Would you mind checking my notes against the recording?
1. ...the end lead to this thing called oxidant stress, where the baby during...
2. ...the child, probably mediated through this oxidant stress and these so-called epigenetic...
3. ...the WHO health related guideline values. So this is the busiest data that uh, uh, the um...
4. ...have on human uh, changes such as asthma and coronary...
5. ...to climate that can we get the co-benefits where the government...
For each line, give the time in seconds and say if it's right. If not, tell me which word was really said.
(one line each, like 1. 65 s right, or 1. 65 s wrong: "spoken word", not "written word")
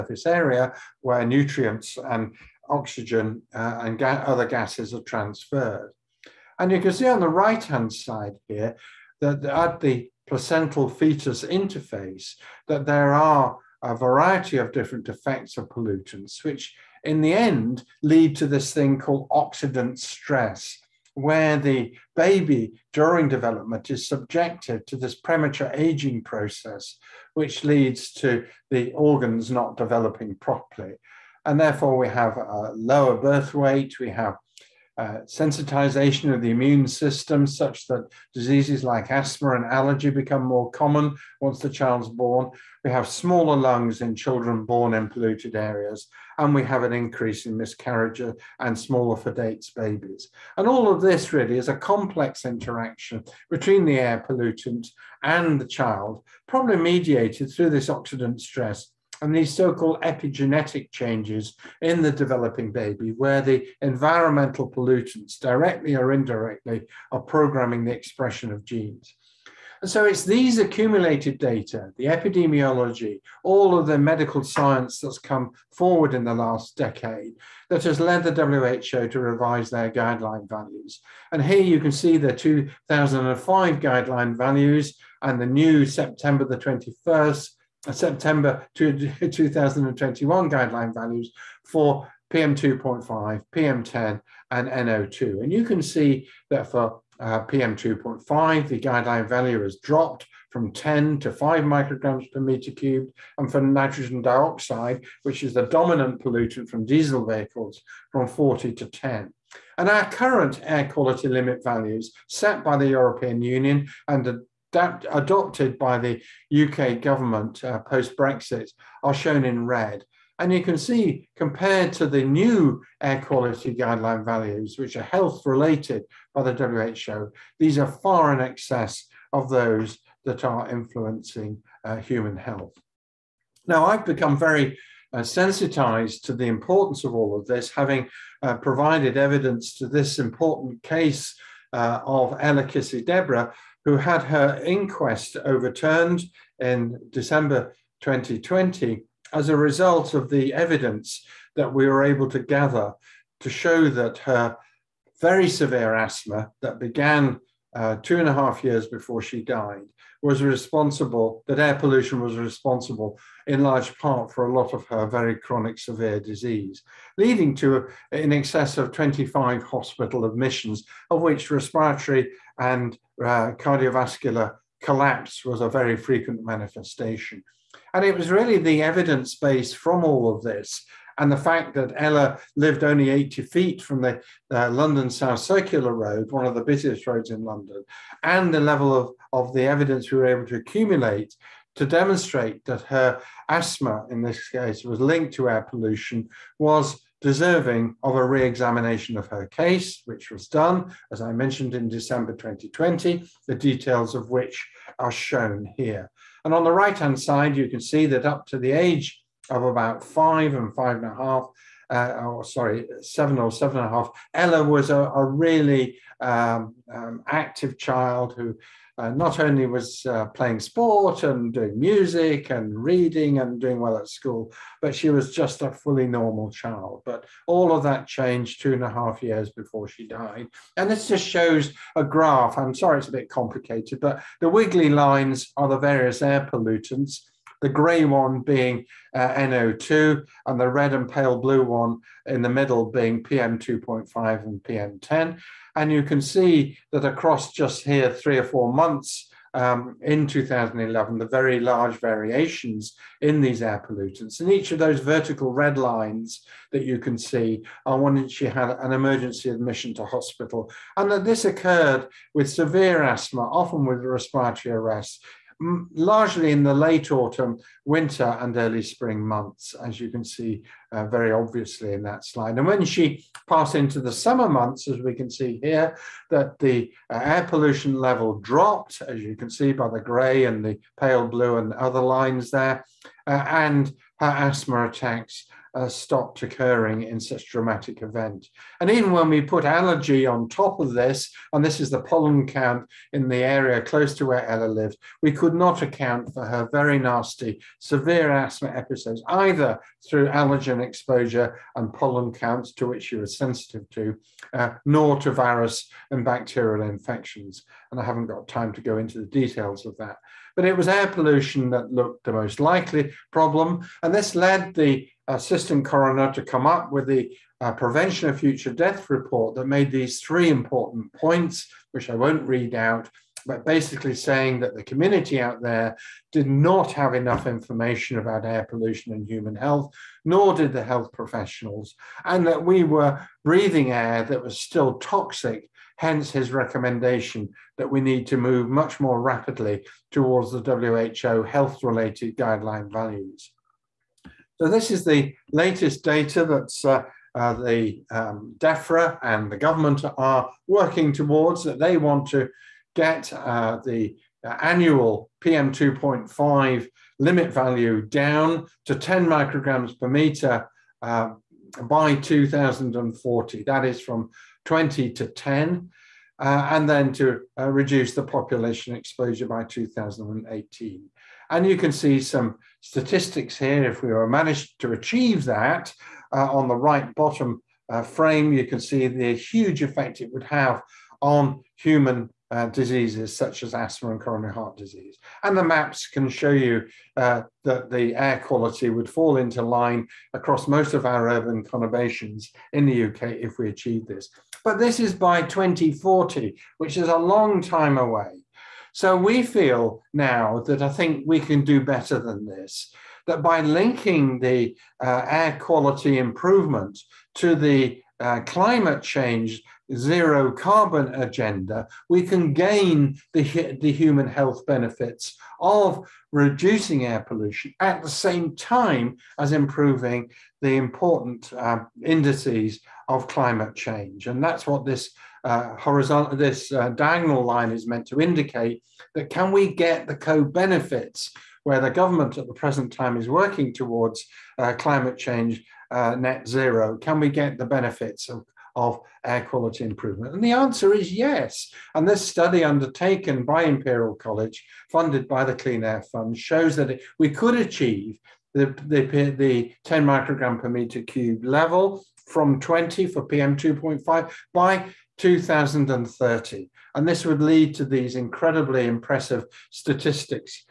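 1. 17 s right
2. 55 s right
3. 340 s wrong: "latest", not "busiest"
4. 380 s wrong: "diseases", not "changes"
5. 428 s wrong: "indicate", not "climate".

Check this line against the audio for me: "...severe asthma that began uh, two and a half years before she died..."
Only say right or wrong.
right.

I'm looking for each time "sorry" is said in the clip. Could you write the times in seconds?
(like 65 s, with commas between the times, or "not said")
212 s, 232 s.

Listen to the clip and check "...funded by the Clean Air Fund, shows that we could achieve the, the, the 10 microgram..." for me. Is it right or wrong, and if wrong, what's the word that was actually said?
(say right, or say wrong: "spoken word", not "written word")
right.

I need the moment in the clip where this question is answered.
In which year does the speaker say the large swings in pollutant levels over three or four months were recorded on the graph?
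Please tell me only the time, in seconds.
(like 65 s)
250 s.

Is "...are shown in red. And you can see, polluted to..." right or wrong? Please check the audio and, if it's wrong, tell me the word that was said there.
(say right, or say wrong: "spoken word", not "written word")
wrong: "compared", not "polluted".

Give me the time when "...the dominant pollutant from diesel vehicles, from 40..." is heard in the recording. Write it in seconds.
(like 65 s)
105 s.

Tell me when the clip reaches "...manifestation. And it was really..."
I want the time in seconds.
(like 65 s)
176 s.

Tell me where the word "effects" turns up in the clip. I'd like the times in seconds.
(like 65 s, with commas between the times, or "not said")
15 s, 379 s.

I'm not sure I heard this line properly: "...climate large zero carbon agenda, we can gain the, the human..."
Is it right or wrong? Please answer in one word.
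wrong.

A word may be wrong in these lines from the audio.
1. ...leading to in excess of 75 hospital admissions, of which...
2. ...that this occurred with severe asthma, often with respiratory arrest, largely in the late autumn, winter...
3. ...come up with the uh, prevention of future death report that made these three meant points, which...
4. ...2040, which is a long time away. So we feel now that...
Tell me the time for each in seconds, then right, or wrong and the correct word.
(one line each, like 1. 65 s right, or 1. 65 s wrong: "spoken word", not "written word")
1. 167 s wrong: "25", not "75"
2. 261 s right
3. 316 s wrong: "important", not "meant"
4. 395 s right.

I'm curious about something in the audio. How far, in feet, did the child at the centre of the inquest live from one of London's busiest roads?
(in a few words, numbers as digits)
80 feet.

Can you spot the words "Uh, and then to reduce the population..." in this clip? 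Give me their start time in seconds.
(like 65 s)
366 s.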